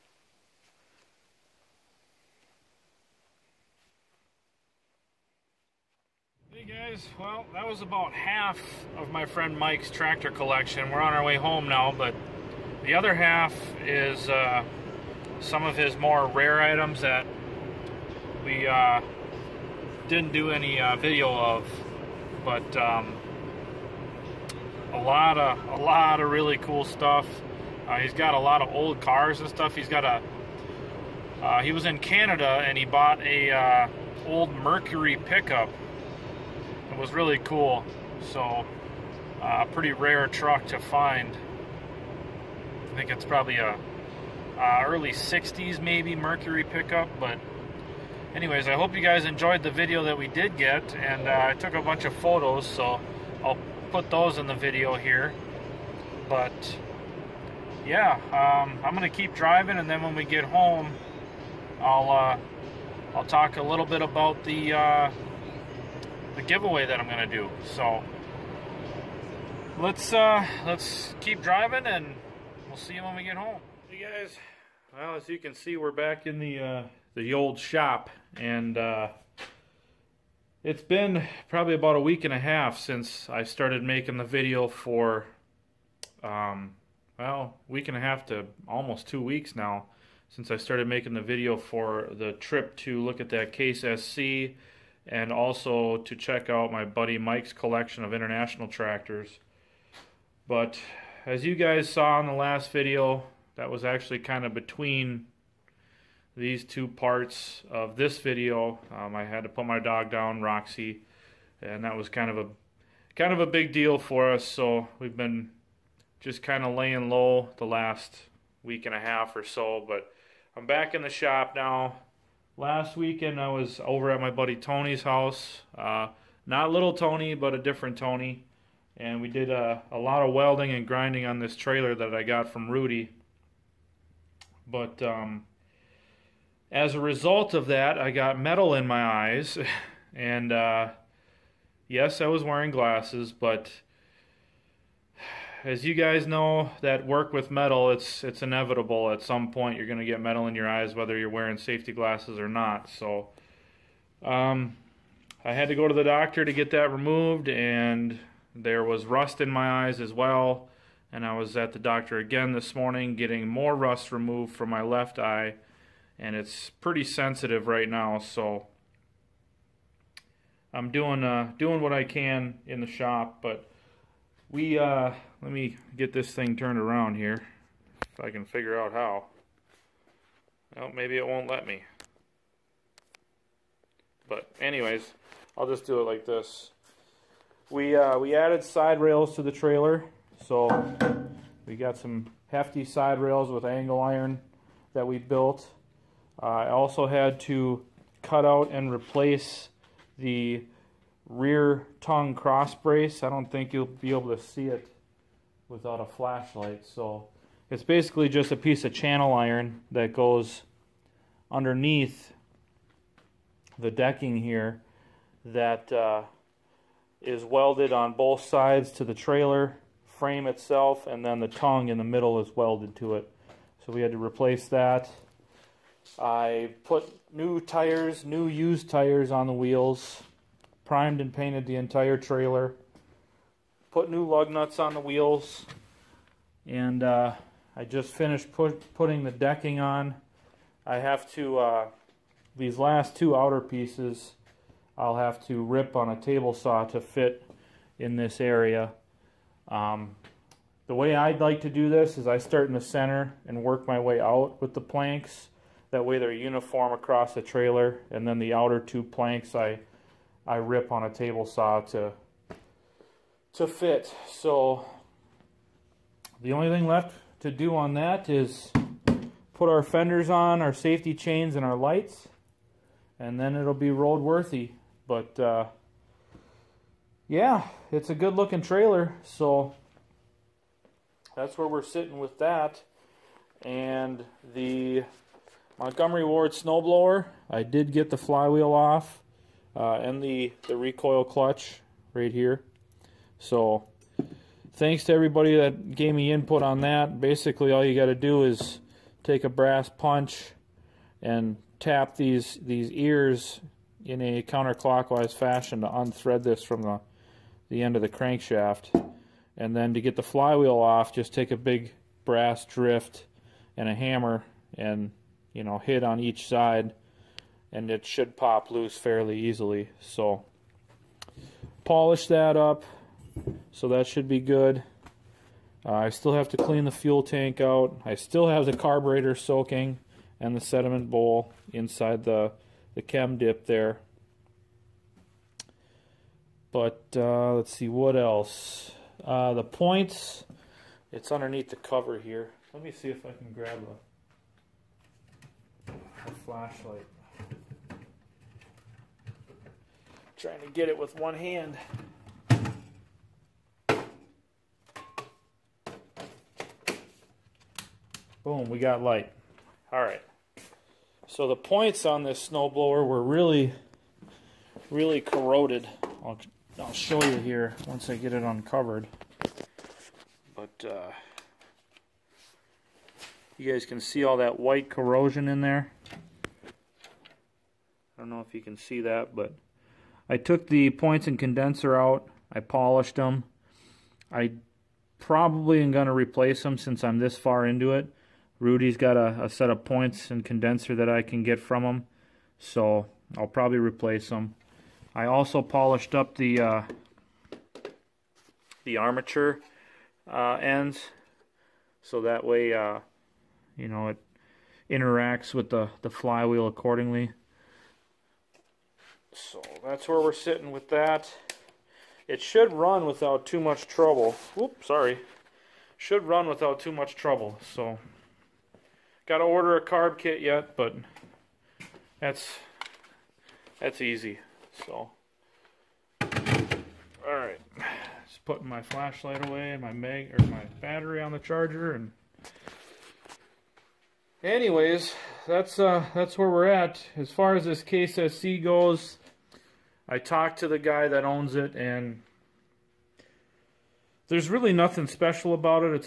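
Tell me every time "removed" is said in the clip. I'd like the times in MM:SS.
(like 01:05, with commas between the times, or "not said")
02:36, 02:44.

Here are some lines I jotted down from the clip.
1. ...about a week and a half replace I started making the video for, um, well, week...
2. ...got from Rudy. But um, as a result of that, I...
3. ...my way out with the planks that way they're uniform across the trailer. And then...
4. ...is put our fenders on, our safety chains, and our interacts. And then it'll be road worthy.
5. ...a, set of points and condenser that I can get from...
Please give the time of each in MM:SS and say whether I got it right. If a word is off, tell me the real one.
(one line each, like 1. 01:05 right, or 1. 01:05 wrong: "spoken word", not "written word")
1. 01:21 wrong: "since", not "replace"
2. 02:12 right
3. 04:13 right
4. 04:28 wrong: "lights", not "interacts"
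5. 06:29 right.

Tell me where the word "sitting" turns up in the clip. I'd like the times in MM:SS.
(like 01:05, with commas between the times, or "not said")
04:41, 06:50.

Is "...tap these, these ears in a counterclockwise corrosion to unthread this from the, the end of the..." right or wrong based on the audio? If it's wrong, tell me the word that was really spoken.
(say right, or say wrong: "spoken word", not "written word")
wrong: "fashion", not "corrosion".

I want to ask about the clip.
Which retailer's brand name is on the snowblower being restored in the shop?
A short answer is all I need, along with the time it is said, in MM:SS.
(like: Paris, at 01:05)
Montgomery Ward, at 04:45.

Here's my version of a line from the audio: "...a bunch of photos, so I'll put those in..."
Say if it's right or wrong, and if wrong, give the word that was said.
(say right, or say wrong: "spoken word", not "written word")
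right.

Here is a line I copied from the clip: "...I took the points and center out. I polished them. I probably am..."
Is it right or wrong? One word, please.
wrong.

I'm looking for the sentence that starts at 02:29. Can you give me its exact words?
At some point, you're going to get metal in your eyes, whether you're wearing safety glasses or not.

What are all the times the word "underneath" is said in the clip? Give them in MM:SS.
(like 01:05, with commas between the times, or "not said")
03:31, 05:41.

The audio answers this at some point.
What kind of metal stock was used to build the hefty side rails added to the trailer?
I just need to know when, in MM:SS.
03:13.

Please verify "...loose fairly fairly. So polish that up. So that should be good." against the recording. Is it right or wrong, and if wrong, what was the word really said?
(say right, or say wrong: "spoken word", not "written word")
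wrong: "easily", not "fairly".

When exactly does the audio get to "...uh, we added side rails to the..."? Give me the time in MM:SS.
03:07.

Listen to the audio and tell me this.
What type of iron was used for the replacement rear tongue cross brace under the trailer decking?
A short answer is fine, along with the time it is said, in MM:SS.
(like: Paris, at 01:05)
Channel iron, at 03:28.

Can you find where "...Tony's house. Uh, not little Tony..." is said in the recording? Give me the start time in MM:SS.
02:04.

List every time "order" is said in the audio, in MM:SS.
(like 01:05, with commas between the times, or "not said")
06:59.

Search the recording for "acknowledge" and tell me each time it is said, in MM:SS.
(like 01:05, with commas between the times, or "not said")
not said.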